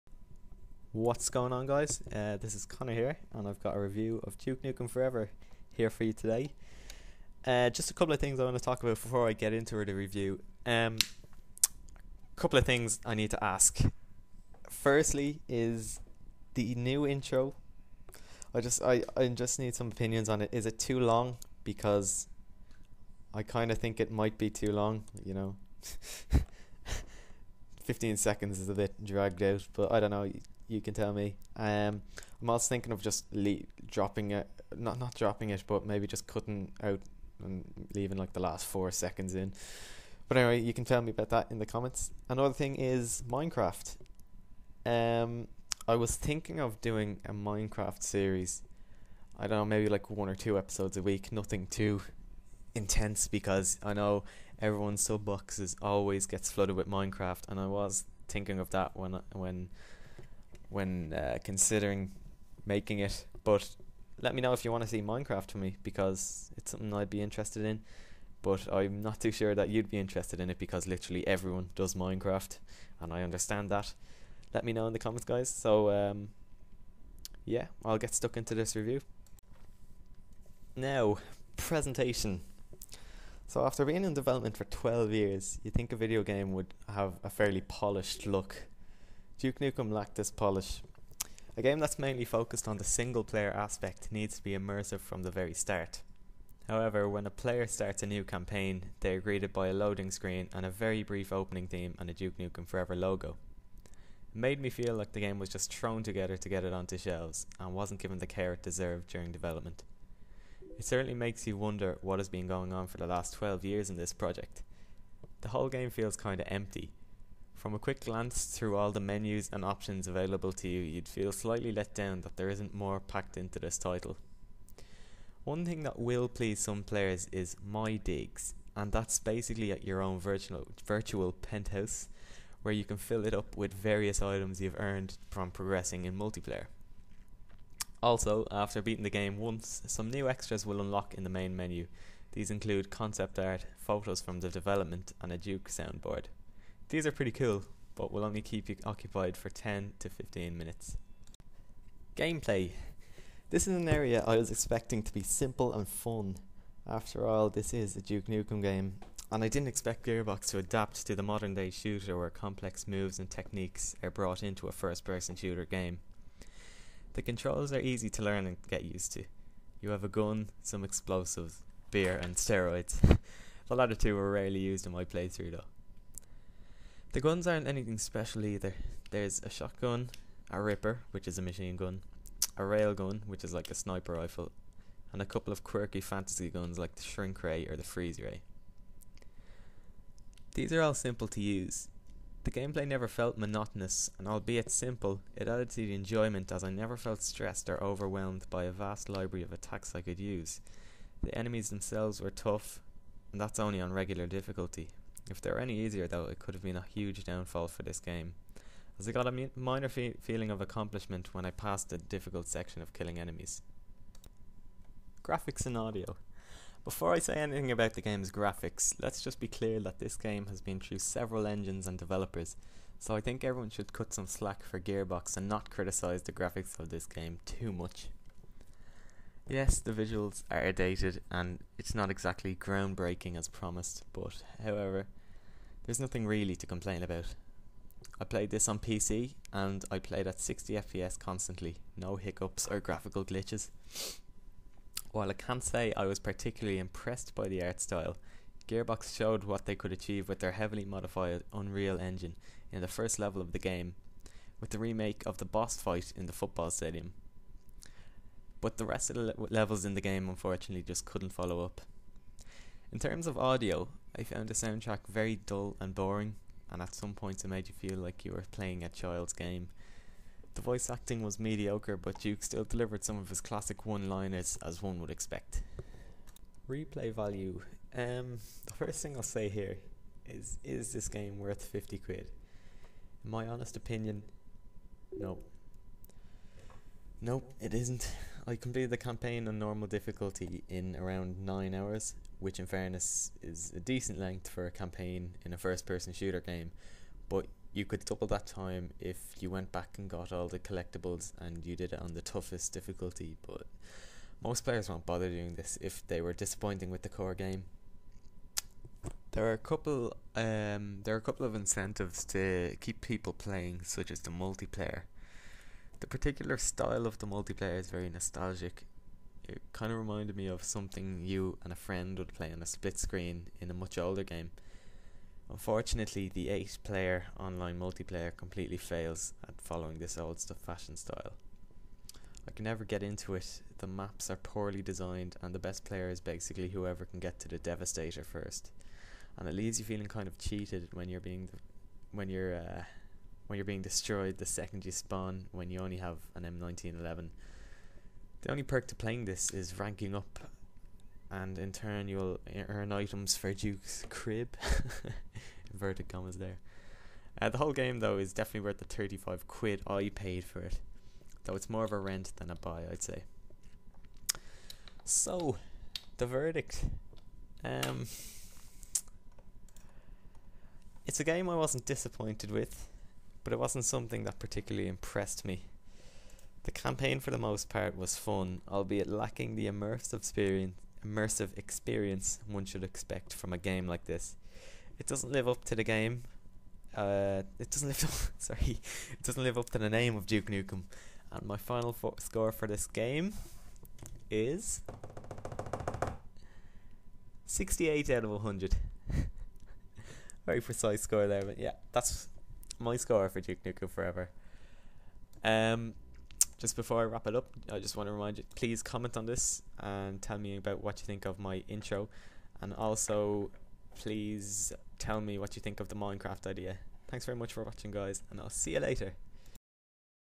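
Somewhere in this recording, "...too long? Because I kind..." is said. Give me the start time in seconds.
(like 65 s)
20 s.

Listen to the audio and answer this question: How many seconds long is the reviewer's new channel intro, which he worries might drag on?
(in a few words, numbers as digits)
15.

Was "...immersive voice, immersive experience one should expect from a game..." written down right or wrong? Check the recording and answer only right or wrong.
wrong.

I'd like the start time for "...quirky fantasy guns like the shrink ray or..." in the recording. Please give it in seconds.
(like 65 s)
185 s.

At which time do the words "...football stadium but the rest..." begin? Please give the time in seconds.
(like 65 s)
256 s.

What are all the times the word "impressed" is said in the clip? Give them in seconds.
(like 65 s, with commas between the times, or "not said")
246 s, 374 s.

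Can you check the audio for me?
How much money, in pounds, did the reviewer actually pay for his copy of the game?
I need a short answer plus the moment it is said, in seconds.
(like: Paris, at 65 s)
35 quid, at 358 s.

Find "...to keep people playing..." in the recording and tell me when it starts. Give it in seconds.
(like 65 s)
312 s.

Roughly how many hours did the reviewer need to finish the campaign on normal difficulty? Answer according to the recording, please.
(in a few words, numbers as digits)
9 hours.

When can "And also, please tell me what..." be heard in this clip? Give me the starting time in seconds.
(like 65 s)
412 s.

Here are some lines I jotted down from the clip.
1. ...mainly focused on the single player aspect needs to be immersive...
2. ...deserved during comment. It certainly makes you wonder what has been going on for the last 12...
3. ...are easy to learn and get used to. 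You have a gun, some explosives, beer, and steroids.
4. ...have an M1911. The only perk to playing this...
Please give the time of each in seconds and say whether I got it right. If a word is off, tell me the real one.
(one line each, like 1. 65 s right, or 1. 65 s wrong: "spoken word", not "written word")
1. 91 s right
2. 108 s wrong: "development", not "comment"
3. 167 s right
4. 345 s right.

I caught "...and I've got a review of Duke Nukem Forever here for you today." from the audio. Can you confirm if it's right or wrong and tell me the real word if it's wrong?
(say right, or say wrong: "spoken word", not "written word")
right.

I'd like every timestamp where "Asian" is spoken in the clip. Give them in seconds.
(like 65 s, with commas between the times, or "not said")
not said.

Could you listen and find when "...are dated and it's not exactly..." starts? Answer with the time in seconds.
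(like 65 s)
230 s.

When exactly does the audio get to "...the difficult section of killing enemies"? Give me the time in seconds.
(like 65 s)
211 s.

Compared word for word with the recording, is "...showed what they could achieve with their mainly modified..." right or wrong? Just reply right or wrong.
wrong.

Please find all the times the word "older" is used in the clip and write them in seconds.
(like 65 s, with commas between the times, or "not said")
323 s.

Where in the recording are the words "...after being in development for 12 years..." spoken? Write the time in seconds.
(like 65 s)
83 s.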